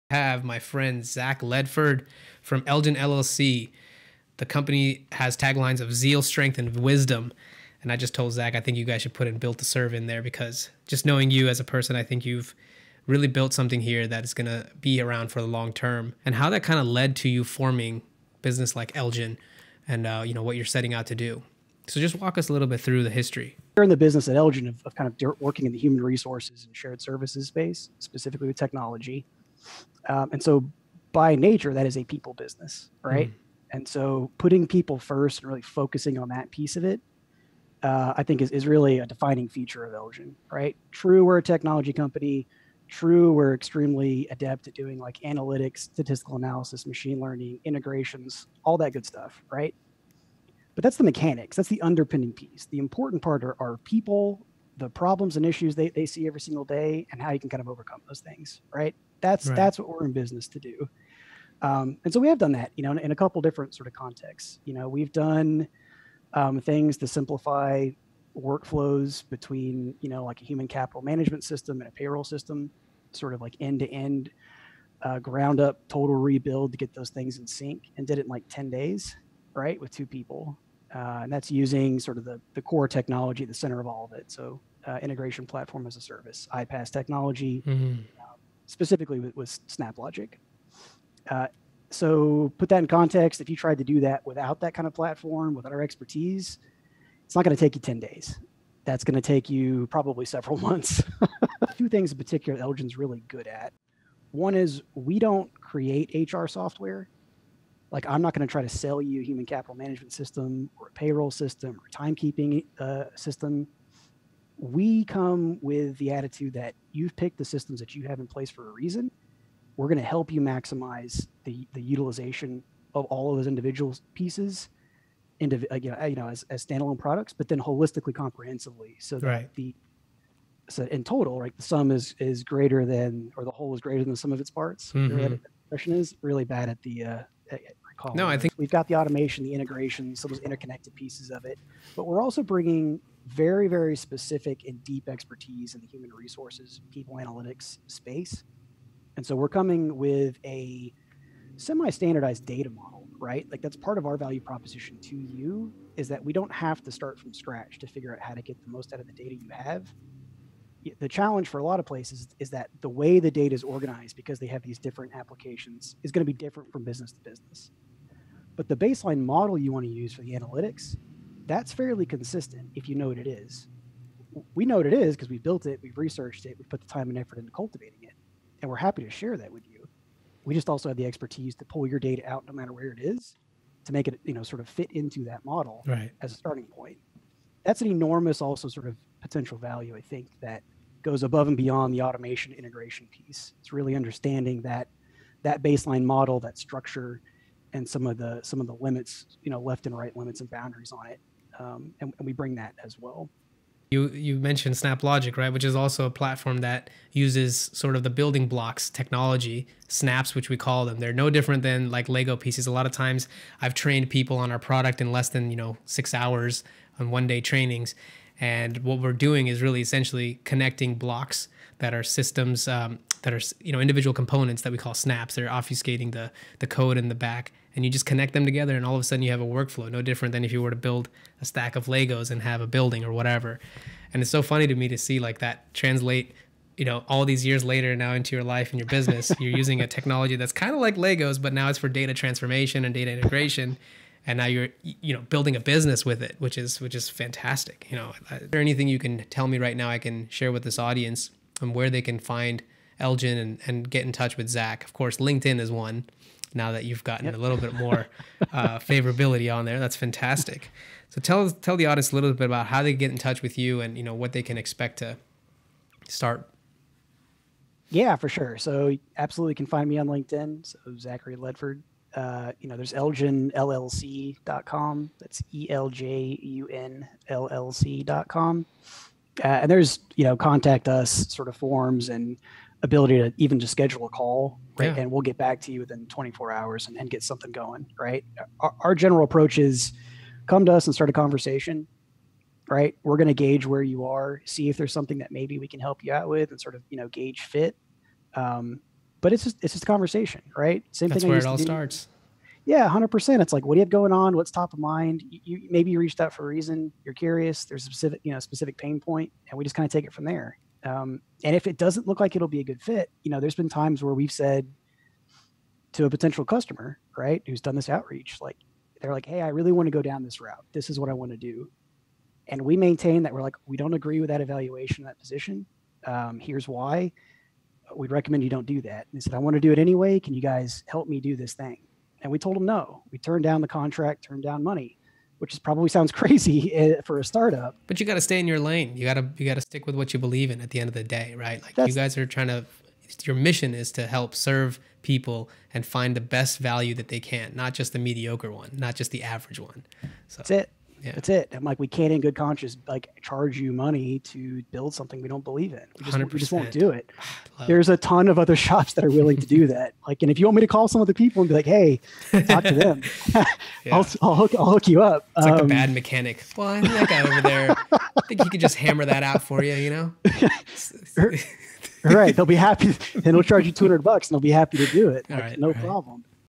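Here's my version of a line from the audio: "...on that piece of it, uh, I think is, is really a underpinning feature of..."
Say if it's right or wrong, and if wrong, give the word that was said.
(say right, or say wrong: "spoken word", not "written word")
wrong: "defining", not "underpinning".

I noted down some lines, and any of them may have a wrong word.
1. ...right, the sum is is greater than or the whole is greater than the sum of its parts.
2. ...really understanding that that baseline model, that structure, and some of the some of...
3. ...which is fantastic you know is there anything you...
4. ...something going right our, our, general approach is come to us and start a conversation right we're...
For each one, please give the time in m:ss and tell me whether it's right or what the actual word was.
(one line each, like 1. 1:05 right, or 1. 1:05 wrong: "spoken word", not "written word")
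1. 2:11 right
2. 3:13 right
3. 4:06 right
4. 4:47 right.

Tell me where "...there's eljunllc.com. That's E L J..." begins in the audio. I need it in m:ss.
4:32.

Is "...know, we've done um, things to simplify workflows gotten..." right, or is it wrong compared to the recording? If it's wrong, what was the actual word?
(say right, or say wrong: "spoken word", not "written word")
wrong: "between", not "gotten".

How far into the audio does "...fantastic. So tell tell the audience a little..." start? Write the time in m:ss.
4:19.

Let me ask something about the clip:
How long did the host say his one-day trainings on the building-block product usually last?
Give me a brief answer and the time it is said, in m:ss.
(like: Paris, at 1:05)
less than 6 hours, at 3:35.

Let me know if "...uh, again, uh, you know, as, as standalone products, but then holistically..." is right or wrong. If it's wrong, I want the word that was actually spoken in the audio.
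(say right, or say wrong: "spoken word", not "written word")
right.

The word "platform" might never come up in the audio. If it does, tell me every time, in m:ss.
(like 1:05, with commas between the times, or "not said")
1:25, 1:34, 3:26.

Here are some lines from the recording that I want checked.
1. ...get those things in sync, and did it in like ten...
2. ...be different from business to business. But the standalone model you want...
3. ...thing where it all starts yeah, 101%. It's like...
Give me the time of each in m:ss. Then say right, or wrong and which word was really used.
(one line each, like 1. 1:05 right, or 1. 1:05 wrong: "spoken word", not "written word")
1. 1:16 right
2. 2:46 wrong: "baseline", not "standalone"
3. 5:01 wrong: "100", not "101".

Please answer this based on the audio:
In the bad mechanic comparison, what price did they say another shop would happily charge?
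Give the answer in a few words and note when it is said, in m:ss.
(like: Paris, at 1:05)
200 bucks, at 6:13.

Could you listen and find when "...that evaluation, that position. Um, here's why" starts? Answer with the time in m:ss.
5:24.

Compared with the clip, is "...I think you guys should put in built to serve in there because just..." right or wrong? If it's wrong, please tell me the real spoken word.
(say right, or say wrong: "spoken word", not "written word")
right.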